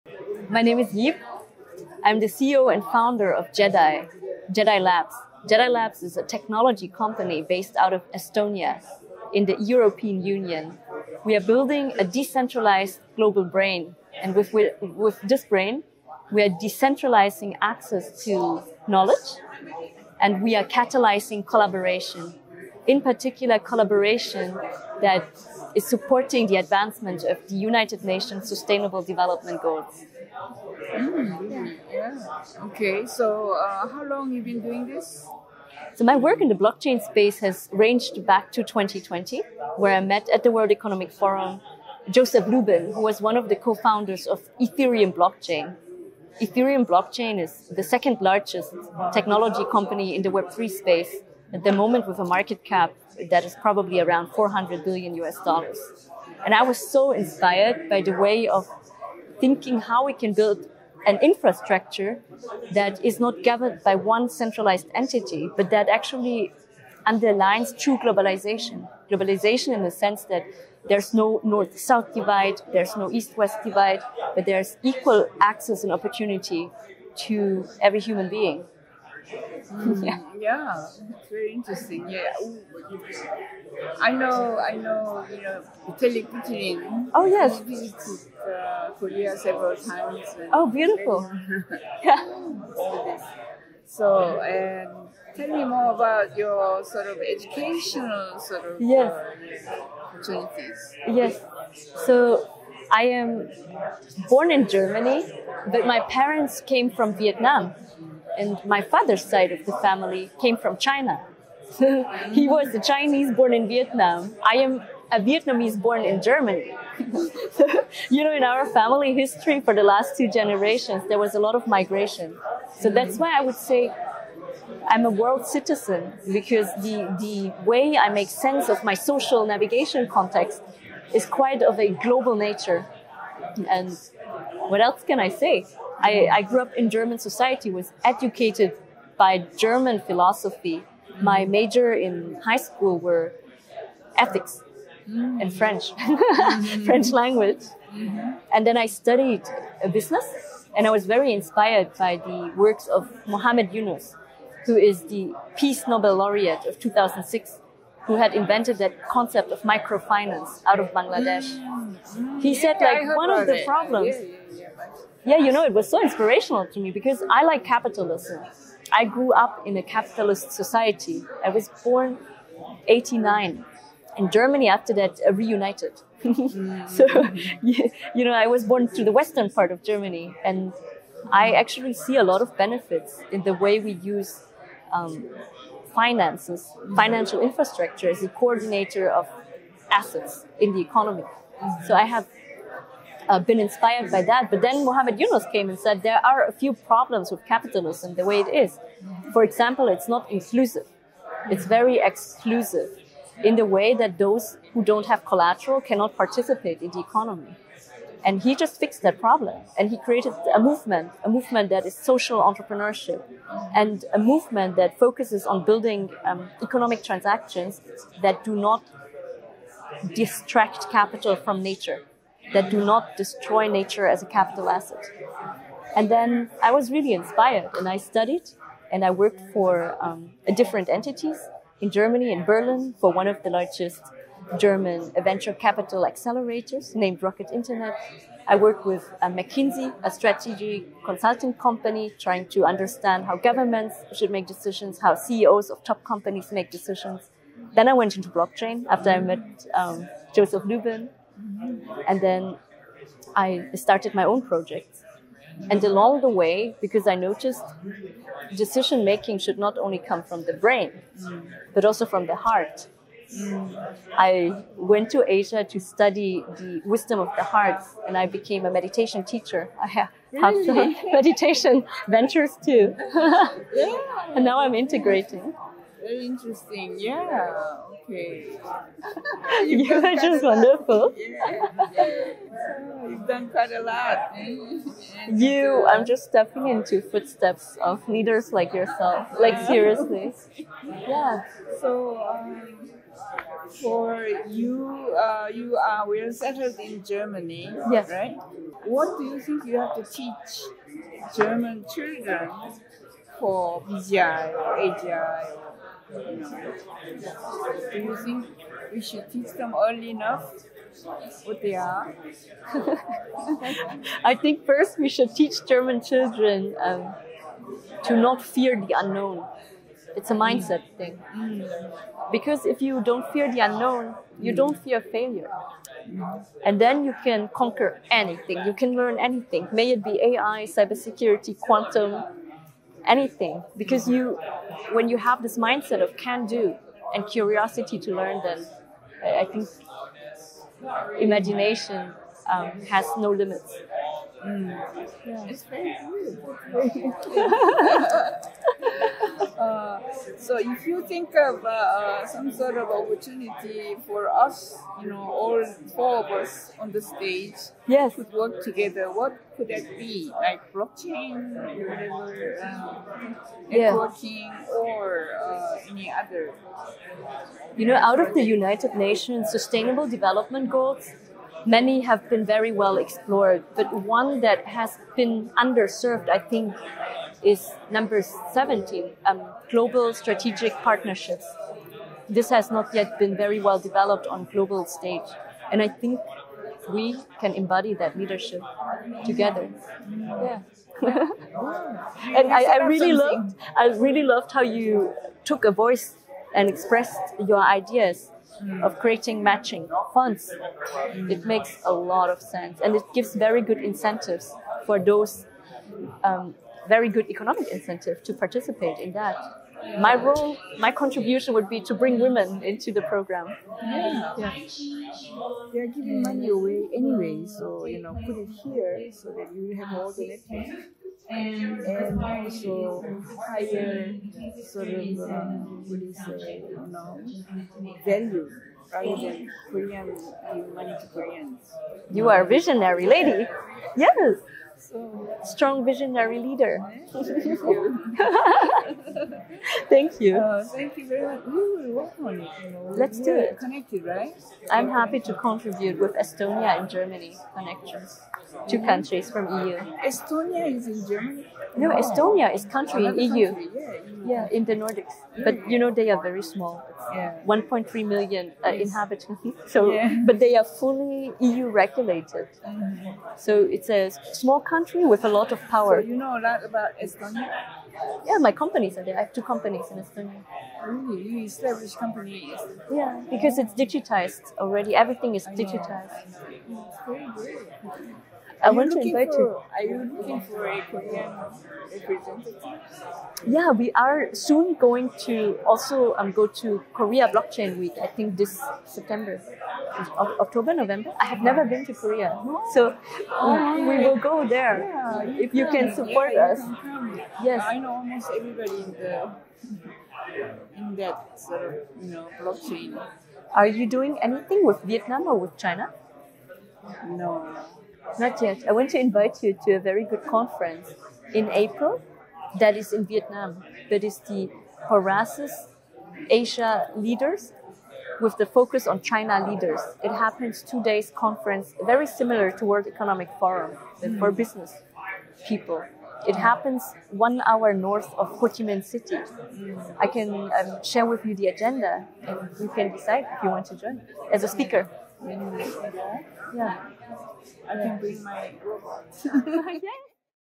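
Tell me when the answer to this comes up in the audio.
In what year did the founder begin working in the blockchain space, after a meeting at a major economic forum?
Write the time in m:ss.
0:38.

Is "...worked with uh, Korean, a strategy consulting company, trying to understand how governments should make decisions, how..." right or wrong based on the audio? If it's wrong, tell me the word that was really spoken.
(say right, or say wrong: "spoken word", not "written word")
wrong: "McKinsey", not "Korean".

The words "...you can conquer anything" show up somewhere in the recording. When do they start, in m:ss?
5:27.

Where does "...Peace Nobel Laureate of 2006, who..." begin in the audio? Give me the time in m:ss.
2:35.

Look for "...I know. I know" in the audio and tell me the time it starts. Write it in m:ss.
1:24.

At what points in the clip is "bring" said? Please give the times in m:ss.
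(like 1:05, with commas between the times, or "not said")
6:51, 8:57.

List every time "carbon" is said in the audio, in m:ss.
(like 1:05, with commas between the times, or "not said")
not said.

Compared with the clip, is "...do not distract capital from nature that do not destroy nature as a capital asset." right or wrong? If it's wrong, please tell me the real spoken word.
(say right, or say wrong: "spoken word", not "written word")
right.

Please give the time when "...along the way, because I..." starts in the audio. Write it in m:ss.
4:15.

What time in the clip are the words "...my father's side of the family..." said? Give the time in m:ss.
1:48.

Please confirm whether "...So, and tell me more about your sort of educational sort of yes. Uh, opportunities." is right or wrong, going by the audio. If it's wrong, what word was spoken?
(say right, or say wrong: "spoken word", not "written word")
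right.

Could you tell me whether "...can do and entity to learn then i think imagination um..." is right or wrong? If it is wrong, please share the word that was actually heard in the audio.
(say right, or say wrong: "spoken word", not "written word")
wrong: "curiosity", not "entity".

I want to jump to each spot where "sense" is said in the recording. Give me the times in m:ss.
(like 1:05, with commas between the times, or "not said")
1:10, 2:08, 6:42.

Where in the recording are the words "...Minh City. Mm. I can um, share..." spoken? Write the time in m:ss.
8:48.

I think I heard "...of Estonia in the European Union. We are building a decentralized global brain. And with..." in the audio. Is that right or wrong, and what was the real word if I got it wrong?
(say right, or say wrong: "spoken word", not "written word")
right.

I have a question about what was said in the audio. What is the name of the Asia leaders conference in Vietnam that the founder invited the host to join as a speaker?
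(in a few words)
Horasis.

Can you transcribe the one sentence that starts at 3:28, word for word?
And he just fixed that problem.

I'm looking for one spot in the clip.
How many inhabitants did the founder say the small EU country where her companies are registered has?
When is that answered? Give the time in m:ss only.
7:37.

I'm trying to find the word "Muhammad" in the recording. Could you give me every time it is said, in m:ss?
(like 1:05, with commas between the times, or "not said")
2:33, 3:14.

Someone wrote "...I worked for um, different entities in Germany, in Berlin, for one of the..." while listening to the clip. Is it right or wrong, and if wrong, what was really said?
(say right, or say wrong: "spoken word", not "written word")
right.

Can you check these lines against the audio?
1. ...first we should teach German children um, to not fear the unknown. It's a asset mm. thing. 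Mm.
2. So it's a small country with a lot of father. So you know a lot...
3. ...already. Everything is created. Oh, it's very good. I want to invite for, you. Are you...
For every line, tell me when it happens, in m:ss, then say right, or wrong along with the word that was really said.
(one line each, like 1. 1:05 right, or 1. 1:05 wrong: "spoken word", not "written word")
1. 5:14 wrong: "mindset", not "asset"
2. 7:43 wrong: "power", not "father"
3. 7:54 wrong: "digitized", not "created".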